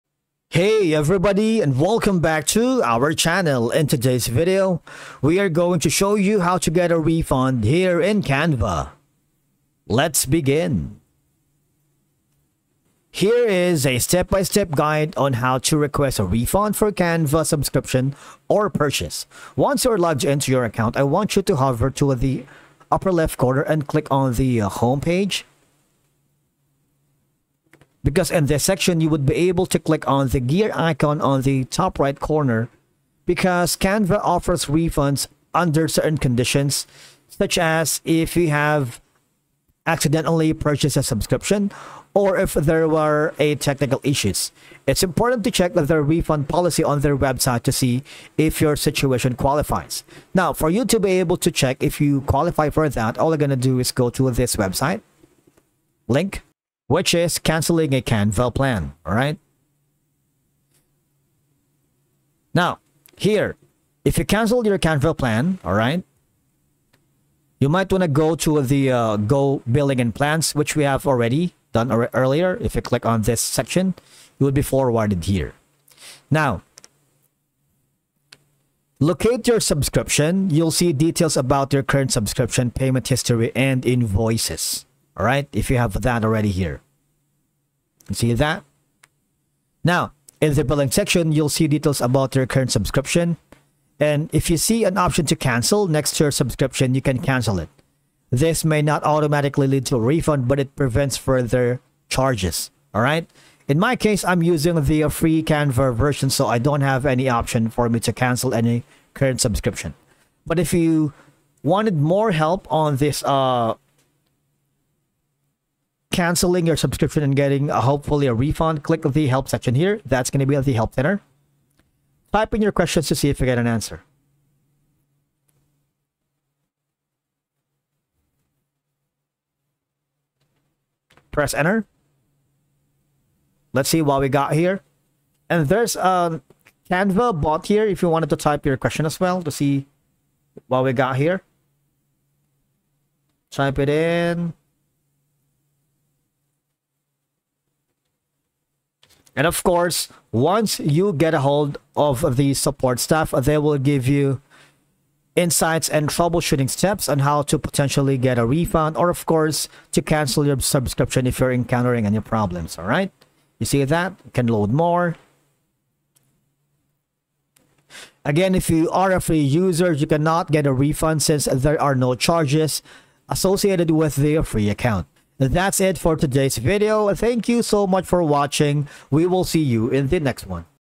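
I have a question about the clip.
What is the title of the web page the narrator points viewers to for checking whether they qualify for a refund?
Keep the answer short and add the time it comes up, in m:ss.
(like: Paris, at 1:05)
Canceling a Canva plan, at 0:57.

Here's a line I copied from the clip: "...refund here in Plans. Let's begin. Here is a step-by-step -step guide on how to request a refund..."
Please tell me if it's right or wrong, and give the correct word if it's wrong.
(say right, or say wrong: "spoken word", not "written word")
wrong: "Canva", not "Plans".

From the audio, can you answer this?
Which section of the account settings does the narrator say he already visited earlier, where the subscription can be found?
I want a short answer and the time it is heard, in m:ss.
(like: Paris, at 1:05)
Billing and Plans, at 1:09.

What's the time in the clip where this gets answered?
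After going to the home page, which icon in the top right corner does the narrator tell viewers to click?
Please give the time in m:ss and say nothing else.
0:30.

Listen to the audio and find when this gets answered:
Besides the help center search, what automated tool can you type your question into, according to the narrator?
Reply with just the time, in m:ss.
2:16.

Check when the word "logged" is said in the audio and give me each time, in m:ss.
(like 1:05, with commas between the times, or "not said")
0:20.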